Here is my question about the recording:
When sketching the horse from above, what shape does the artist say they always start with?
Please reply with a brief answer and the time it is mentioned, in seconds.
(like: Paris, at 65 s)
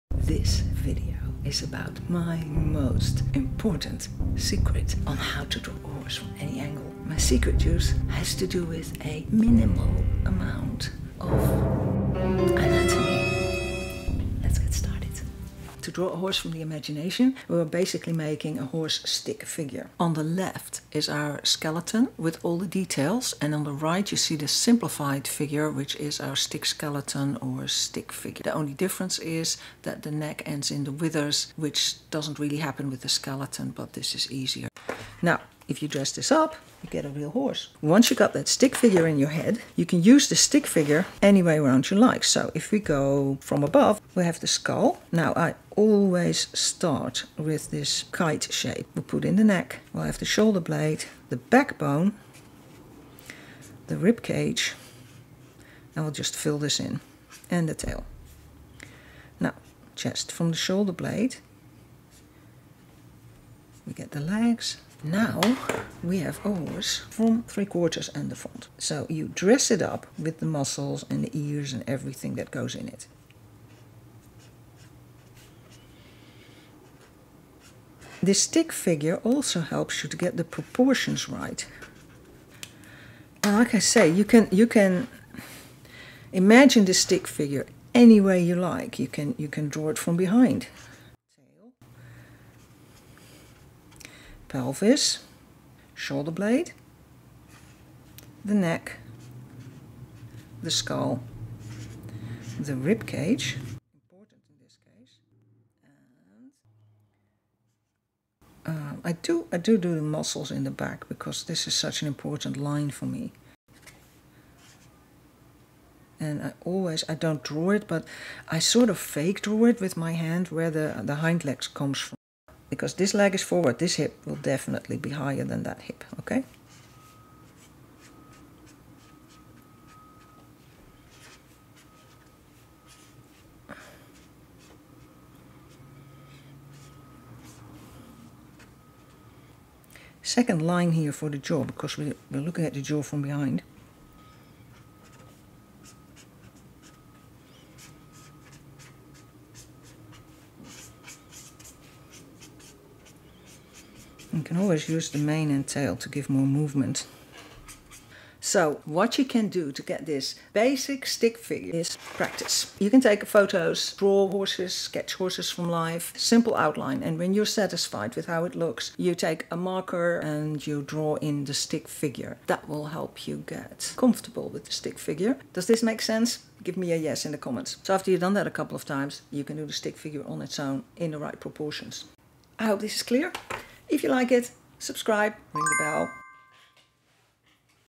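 Kite shape, at 48 s.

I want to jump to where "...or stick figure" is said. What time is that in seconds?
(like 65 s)
27 s.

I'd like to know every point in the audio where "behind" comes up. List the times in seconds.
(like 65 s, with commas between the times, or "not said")
90 s, 143 s.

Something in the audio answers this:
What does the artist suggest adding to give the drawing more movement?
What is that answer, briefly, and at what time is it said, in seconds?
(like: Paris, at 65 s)
The mane and tail, at 155 s.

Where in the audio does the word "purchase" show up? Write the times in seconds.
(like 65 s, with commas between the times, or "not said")
not said.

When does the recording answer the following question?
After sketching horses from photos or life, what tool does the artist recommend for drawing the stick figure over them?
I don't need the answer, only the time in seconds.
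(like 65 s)
169 s.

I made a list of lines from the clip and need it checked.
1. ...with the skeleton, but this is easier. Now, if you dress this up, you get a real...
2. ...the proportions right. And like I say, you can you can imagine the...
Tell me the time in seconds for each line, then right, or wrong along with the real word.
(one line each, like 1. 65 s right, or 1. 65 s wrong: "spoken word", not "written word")
1. 32 s right
2. 80 s right.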